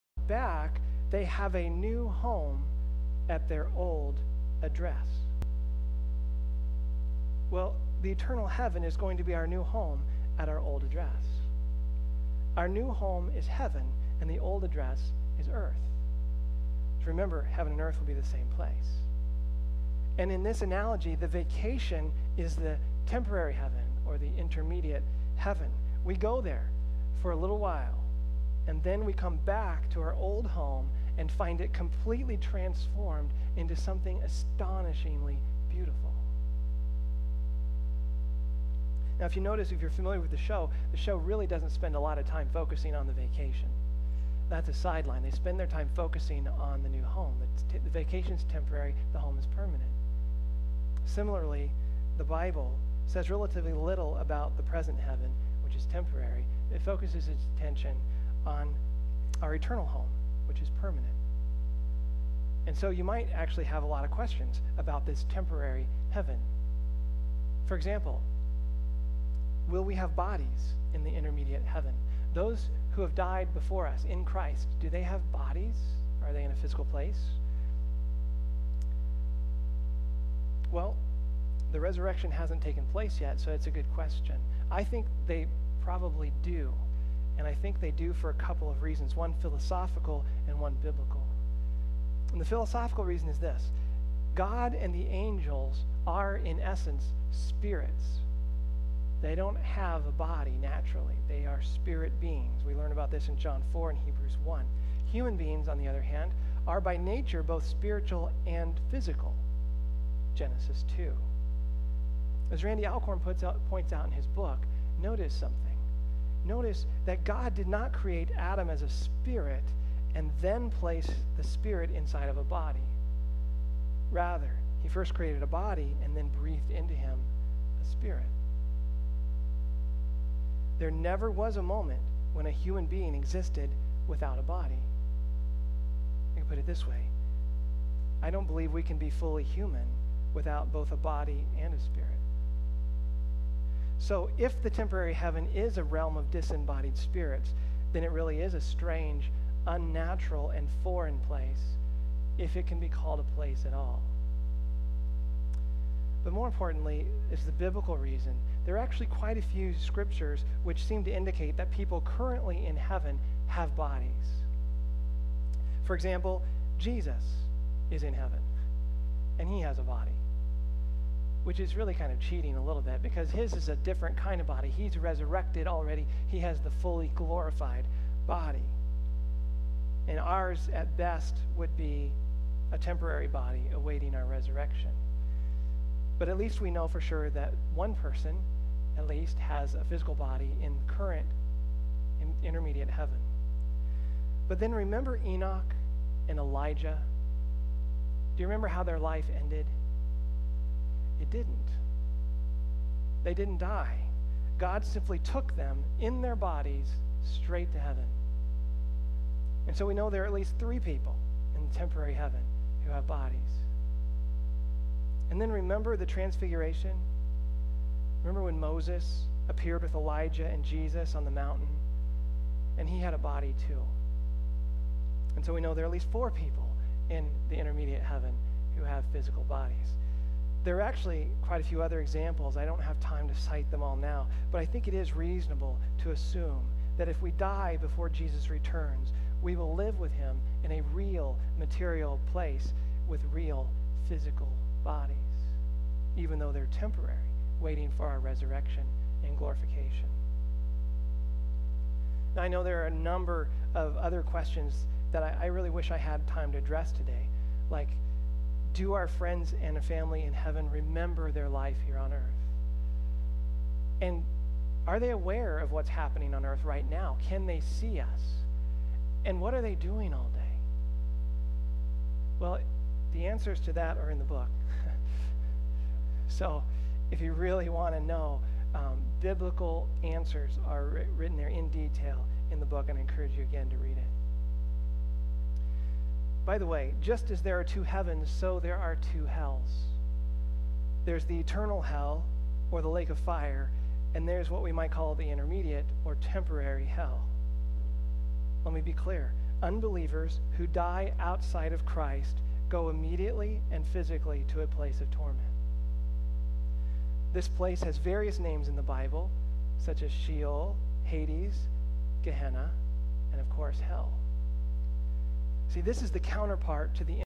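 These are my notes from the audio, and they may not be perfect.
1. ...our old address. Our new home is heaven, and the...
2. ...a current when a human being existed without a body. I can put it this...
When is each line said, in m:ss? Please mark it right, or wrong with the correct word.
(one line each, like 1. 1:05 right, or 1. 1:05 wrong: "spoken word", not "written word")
1. 0:10 right
2. 2:11 wrong: "moment", not "current".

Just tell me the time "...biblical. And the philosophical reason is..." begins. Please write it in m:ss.
1:30.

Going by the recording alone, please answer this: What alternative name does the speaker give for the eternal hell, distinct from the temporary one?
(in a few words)
the lake of fire.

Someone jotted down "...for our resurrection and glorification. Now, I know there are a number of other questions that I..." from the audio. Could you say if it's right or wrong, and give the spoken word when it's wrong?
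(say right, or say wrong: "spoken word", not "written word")
right.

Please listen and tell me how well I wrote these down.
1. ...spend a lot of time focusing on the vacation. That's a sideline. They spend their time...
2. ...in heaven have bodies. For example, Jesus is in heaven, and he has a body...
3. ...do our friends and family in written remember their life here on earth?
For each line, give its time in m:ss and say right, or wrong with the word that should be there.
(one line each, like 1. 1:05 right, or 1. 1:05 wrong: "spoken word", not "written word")
1. 0:41 right
2. 2:42 right
3. 4:18 wrong: "heaven", not "written".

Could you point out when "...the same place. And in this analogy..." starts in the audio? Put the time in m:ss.
0:18.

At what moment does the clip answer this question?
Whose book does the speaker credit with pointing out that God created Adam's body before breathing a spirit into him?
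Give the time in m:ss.
1:52.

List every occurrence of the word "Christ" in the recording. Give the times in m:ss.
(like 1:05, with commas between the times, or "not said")
1:14, 5:01.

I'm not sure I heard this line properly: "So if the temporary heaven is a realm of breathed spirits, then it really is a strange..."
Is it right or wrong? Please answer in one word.
wrong.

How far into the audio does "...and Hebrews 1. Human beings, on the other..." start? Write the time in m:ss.
1:43.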